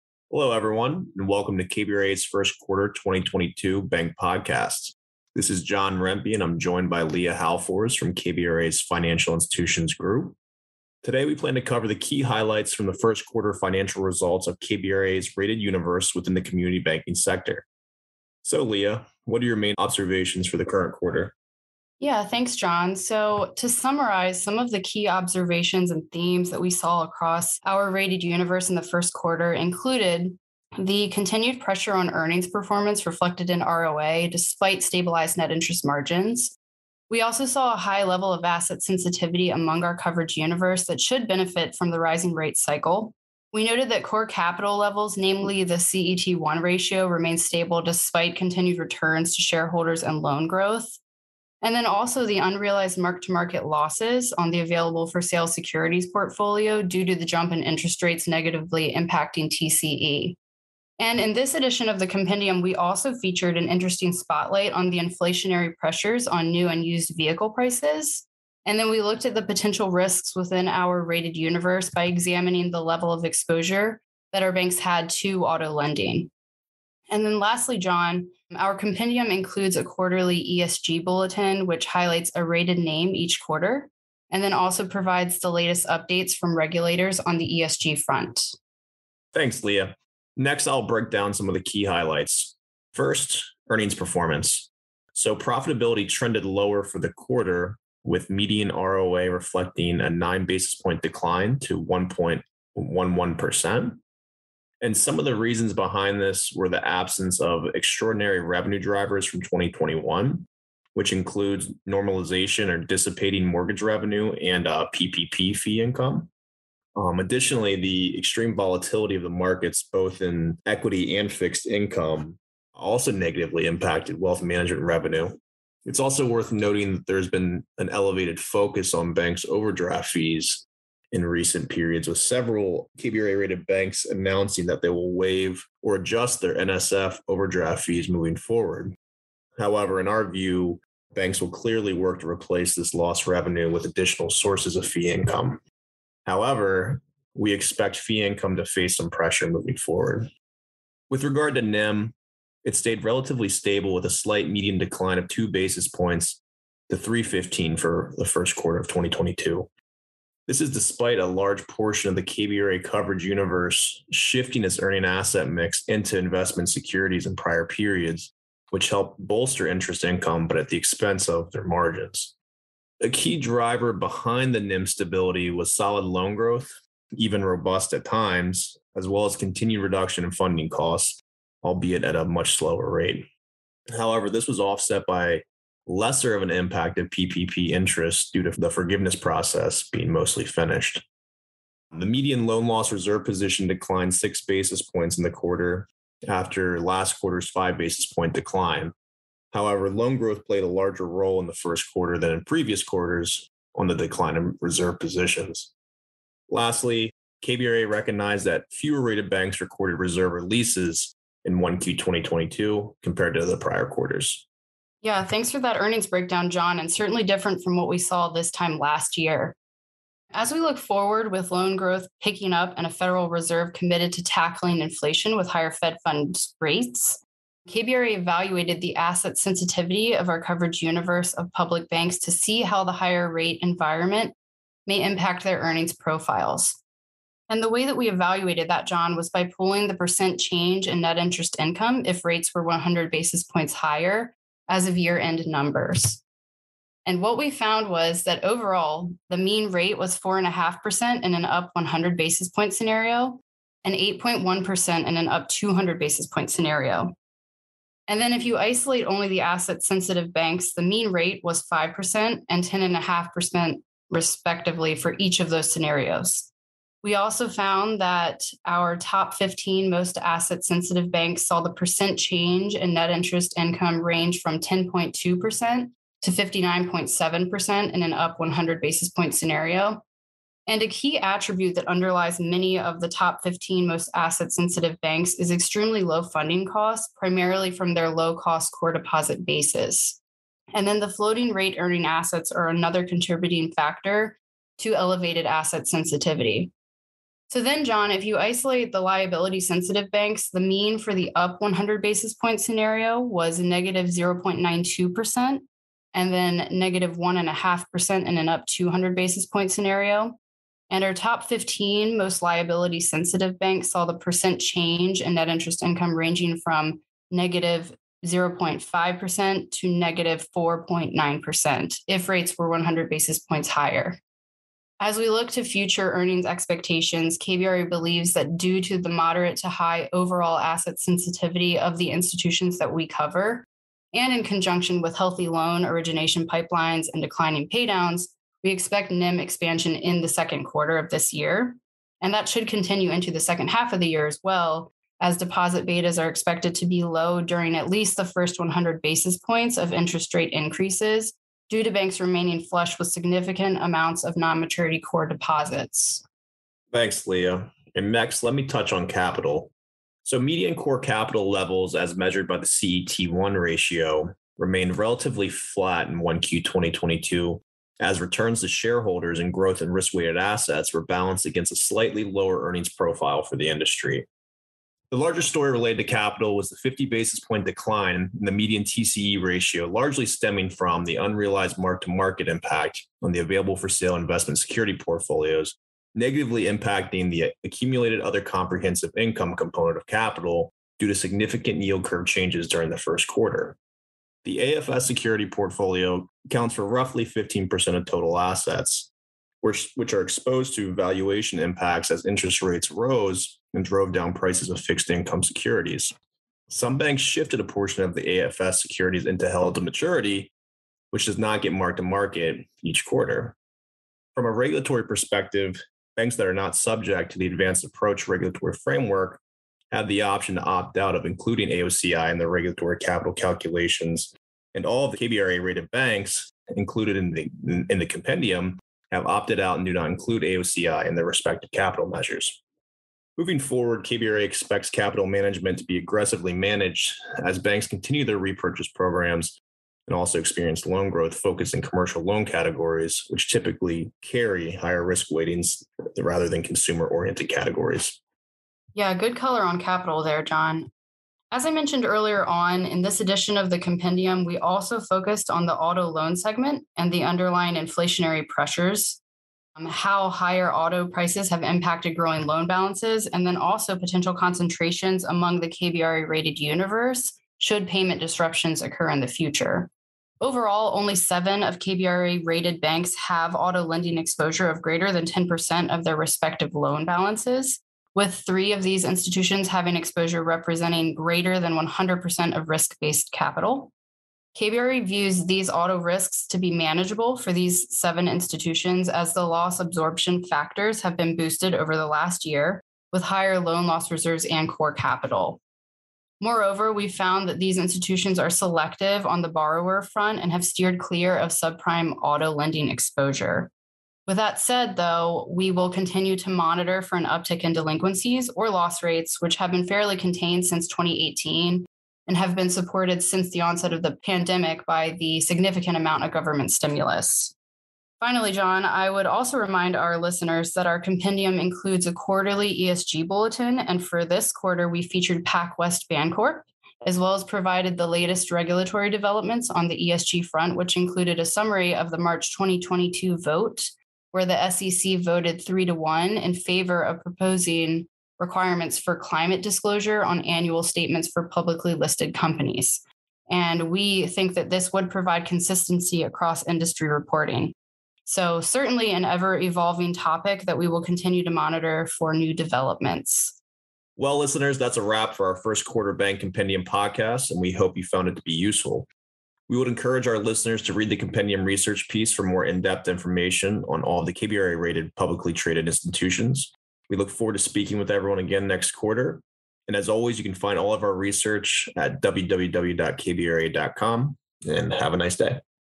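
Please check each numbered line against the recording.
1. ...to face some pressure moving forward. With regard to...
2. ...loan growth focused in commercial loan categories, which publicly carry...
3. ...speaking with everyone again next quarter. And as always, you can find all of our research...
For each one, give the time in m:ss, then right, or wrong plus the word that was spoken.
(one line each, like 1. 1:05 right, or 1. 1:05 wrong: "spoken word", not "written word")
1. 2:28 right
2. 7:20 wrong: "typically", not "publicly"
3. 9:27 right.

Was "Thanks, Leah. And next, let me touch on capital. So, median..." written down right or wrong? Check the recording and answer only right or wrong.
right.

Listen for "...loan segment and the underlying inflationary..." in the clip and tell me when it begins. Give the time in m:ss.
7:36.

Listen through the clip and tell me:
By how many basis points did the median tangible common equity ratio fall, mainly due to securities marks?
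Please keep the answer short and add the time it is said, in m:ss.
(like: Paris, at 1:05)
50 basis points, at 6:16.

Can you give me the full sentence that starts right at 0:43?
We noted that core capital levels, namely the CET1 ratio, remained stable despite continued returns to shareholders and loan growth.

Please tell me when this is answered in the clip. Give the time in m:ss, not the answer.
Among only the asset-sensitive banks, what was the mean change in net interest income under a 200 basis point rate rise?
4:22.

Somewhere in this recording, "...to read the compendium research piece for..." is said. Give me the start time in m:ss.
9:20.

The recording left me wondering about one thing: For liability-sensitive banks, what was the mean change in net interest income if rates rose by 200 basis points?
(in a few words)
-1.5%.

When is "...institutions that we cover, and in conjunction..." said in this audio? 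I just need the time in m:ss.
5:32.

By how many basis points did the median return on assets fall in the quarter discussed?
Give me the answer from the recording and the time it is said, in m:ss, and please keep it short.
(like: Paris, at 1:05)
9 basis points, at 1:40.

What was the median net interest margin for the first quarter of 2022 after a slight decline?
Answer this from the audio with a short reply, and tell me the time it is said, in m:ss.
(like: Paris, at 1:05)
3.15%, at 2:36.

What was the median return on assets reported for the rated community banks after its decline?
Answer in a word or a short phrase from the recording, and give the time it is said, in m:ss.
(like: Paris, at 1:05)
1.11%, at 1:41.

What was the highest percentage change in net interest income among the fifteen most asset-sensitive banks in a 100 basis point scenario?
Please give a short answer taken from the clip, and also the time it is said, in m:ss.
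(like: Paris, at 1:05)
59.7%, at 4:36.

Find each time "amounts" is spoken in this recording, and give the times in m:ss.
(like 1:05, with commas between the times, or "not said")
5:53, 8:35.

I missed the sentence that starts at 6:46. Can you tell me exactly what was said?
Some banks shifted a portion of the AFS securities into held to maturity, which does not get marked to market each quarter.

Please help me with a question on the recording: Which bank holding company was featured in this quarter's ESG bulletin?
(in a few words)
PacWest Bancorp.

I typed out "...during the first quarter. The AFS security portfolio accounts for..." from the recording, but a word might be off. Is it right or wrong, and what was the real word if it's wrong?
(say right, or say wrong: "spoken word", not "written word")
right.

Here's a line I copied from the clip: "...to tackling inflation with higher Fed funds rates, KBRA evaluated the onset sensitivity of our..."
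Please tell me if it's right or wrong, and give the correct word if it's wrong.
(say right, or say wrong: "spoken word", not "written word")
wrong: "asset", not "onset".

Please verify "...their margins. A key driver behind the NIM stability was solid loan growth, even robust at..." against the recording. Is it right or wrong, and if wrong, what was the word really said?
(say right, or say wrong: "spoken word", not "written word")
right.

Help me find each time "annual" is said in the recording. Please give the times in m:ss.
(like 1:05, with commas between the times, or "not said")
9:00.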